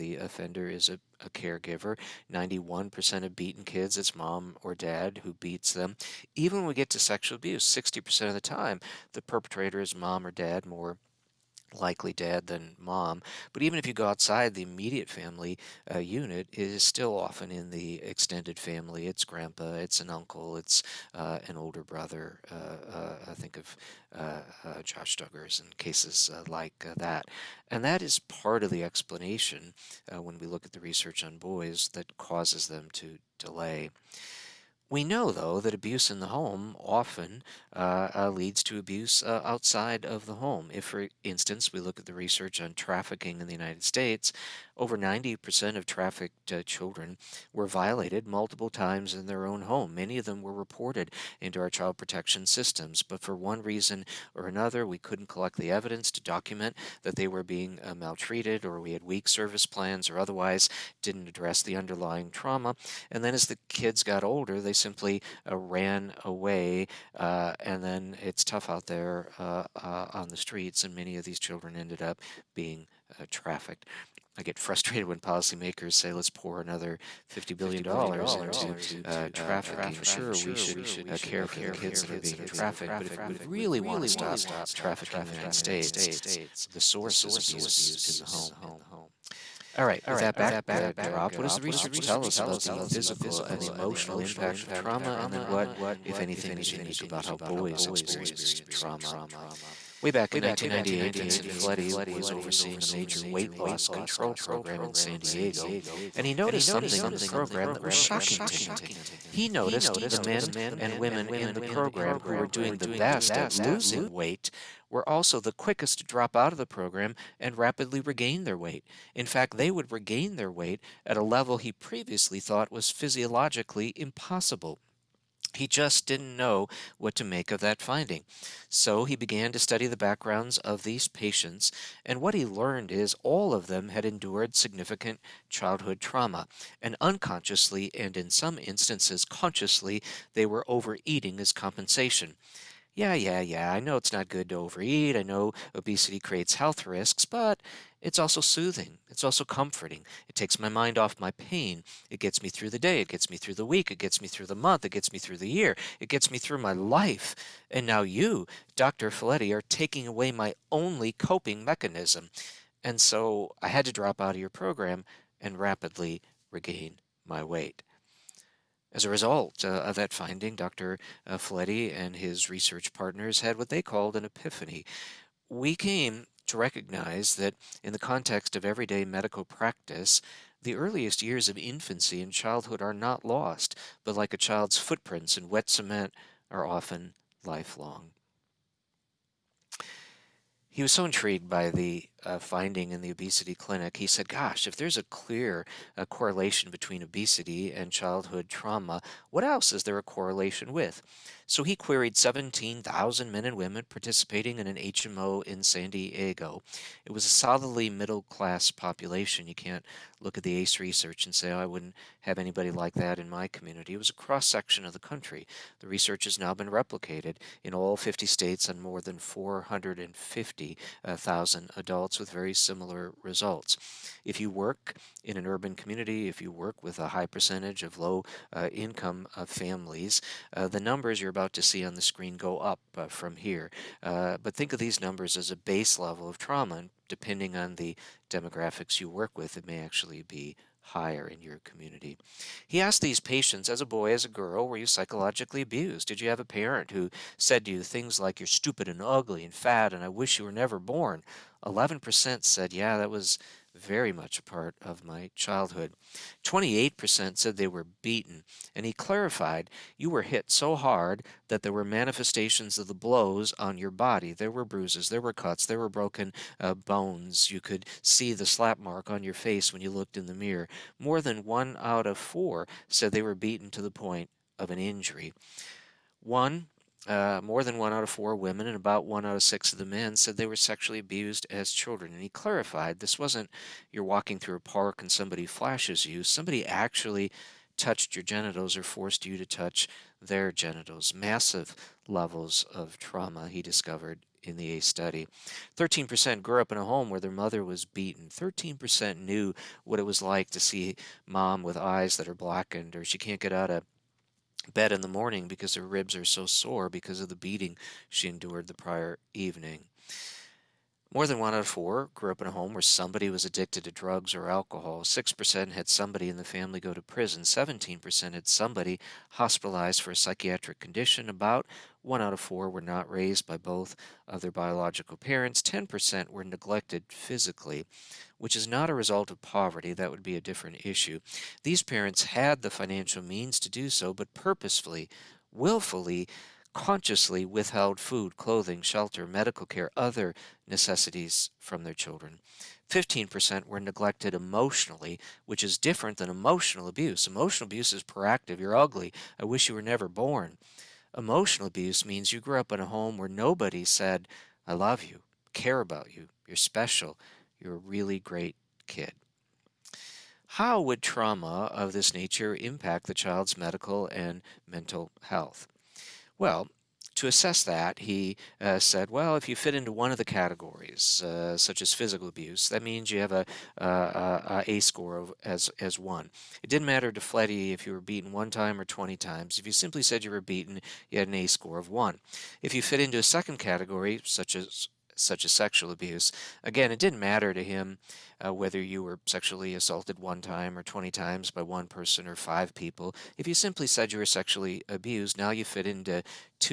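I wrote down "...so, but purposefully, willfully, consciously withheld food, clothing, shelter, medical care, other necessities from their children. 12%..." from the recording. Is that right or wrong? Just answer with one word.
wrong.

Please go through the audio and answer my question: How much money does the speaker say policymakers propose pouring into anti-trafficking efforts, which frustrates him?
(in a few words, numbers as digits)
$50 billion.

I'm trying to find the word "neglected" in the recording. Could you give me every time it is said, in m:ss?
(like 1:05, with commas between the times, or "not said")
5:26, 5:43.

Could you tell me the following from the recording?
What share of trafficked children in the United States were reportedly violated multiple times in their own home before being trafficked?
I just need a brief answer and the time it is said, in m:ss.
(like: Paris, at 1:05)
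over 90%, at 0:44.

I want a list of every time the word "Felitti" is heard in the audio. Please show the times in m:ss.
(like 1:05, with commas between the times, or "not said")
1:41, 2:39, 6:17.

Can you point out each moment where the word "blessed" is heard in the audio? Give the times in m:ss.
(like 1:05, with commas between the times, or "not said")
not said.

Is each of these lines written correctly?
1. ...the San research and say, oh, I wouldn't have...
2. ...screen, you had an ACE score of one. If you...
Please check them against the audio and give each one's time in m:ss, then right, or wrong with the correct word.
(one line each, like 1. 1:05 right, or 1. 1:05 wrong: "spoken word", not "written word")
1. 3:30 wrong: "ACE", not "San"
2. 6:20 wrong: "beaten", not "screen".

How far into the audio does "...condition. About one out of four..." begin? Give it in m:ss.
5:20.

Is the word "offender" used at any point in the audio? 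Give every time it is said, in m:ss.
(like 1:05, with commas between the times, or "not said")
0:00.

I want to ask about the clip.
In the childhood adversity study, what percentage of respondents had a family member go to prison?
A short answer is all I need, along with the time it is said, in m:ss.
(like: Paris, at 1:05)
6%, at 5:15.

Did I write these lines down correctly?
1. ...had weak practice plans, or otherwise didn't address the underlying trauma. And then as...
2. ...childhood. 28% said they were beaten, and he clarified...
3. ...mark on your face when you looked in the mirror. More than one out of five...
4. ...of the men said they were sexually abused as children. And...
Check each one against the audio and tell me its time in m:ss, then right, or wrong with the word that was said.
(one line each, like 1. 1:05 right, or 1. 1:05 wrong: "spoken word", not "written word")
1. 0:58 wrong: "service", not "practice"
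2. 4:15 right
3. 4:28 wrong: "four", not "five"
4. 4:39 right.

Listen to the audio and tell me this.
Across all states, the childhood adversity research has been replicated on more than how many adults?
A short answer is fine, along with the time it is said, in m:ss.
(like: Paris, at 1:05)
450,000, at 3:39.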